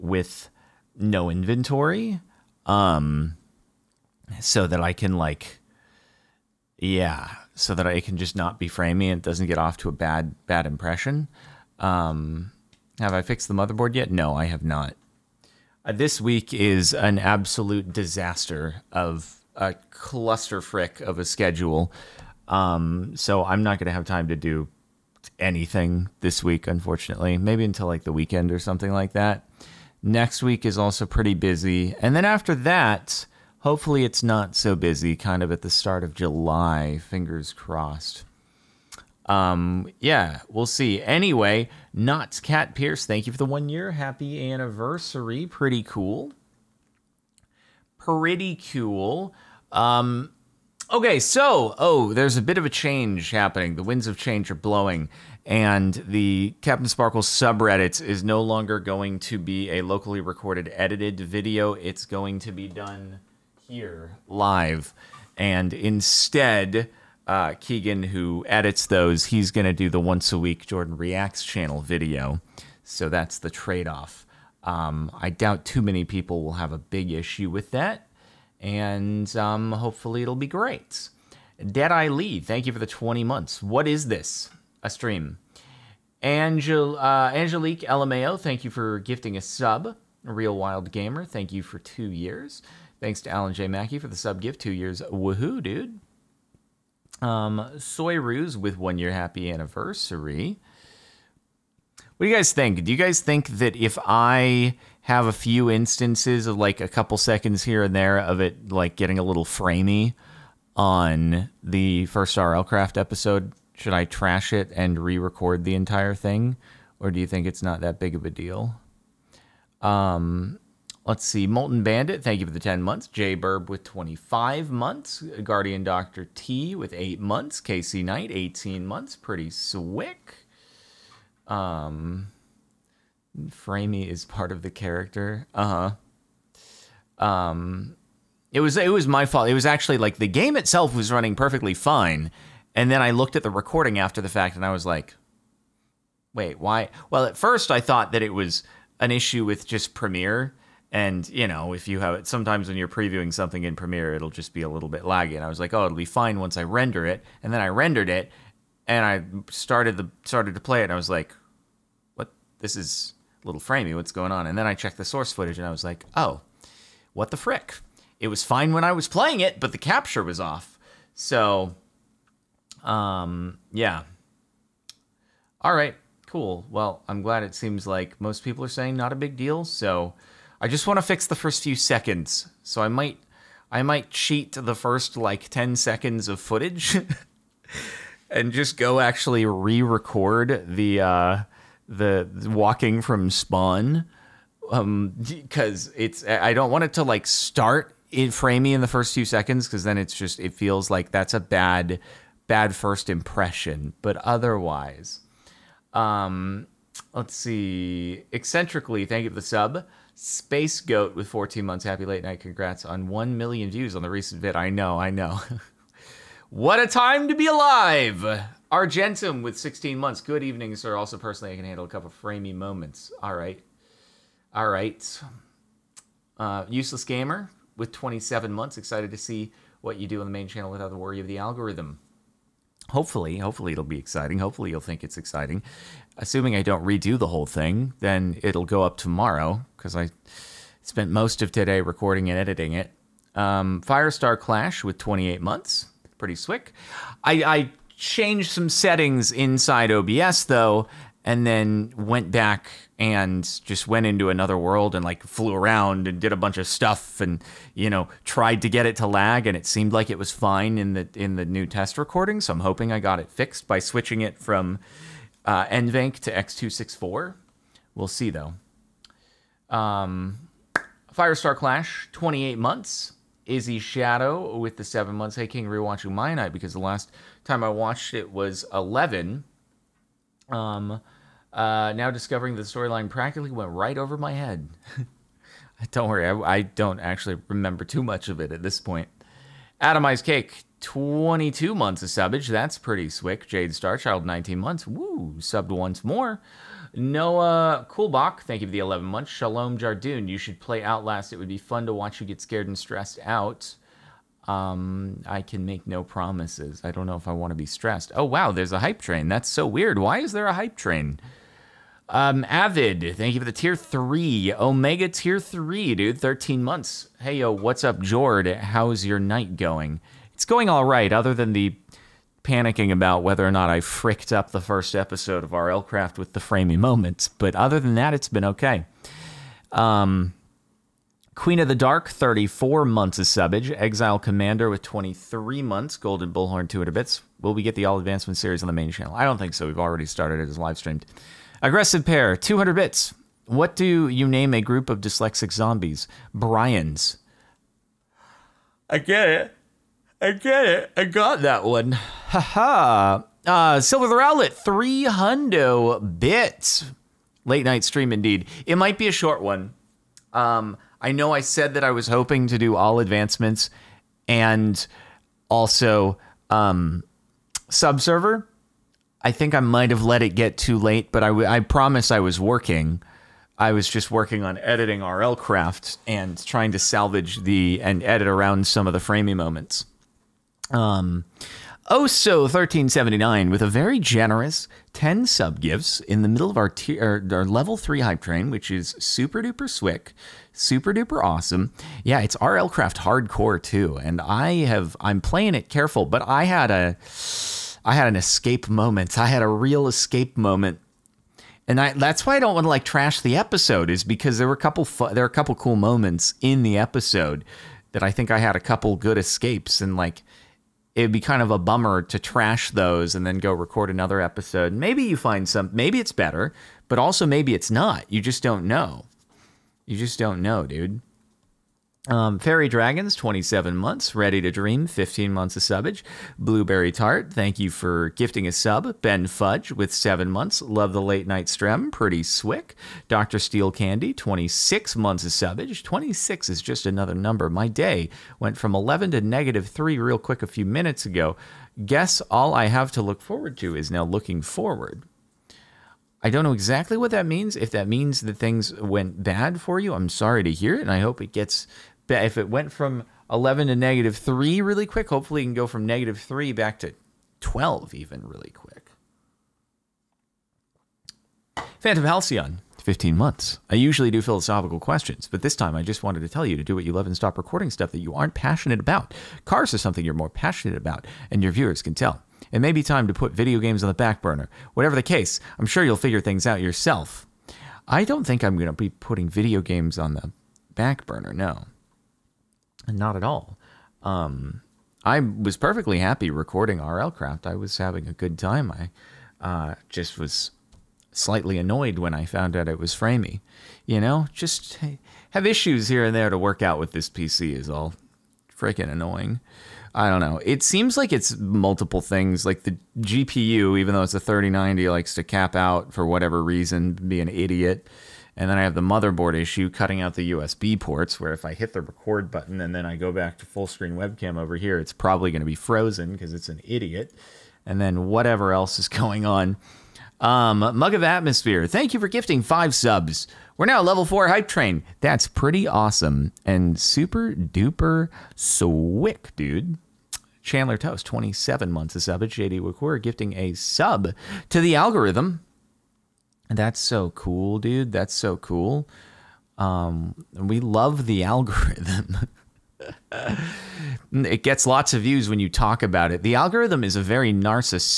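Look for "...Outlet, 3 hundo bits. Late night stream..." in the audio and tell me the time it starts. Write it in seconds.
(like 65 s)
354 s.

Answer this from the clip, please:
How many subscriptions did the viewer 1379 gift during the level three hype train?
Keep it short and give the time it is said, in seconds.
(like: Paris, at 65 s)
10, at 384 s.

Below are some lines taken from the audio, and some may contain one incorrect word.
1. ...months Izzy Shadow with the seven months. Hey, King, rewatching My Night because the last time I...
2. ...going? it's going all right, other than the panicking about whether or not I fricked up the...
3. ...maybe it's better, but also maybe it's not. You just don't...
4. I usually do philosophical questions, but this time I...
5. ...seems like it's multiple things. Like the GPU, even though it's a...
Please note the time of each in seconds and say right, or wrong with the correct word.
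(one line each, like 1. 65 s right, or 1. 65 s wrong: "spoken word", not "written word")
1. 272 s right
2. 319 s right
3. 415 s right
4. 463 s right
5. 500 s right.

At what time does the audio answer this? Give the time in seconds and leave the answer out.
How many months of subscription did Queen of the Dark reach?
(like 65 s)
332 s.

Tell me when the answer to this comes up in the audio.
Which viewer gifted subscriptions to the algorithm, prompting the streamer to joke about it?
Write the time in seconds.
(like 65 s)
532 s.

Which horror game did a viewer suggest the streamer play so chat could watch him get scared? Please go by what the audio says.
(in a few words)
Outlast.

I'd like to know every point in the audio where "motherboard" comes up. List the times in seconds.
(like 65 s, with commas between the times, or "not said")
13 s, 508 s.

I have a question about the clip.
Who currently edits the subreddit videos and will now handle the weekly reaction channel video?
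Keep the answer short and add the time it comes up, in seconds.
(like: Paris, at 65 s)
Keegan, at 67 s.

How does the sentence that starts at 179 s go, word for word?
So, I just want to fix the first few seconds.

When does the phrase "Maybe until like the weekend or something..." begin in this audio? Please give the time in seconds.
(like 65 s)
27 s.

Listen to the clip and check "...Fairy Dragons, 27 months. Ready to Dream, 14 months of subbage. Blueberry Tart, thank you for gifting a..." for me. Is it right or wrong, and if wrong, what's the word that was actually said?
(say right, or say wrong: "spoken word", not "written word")
wrong: "15", not "14".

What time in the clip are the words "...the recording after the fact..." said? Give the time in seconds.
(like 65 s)
143 s.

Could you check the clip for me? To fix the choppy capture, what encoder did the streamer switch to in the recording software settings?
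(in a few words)
x264.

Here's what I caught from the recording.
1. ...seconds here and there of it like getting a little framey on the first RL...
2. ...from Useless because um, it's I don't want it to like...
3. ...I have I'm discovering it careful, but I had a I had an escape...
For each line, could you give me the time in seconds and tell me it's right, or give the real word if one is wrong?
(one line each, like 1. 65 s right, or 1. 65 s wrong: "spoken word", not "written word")
1. 107 s right
2. 193 s wrong: "Spawn", not "Useless"
3. 394 s wrong: "playing", not "discovering".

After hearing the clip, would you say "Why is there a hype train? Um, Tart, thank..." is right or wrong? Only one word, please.
wrong.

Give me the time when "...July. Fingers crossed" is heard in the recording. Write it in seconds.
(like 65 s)
36 s.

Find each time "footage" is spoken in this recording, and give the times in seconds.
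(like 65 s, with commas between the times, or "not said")
165 s, 186 s.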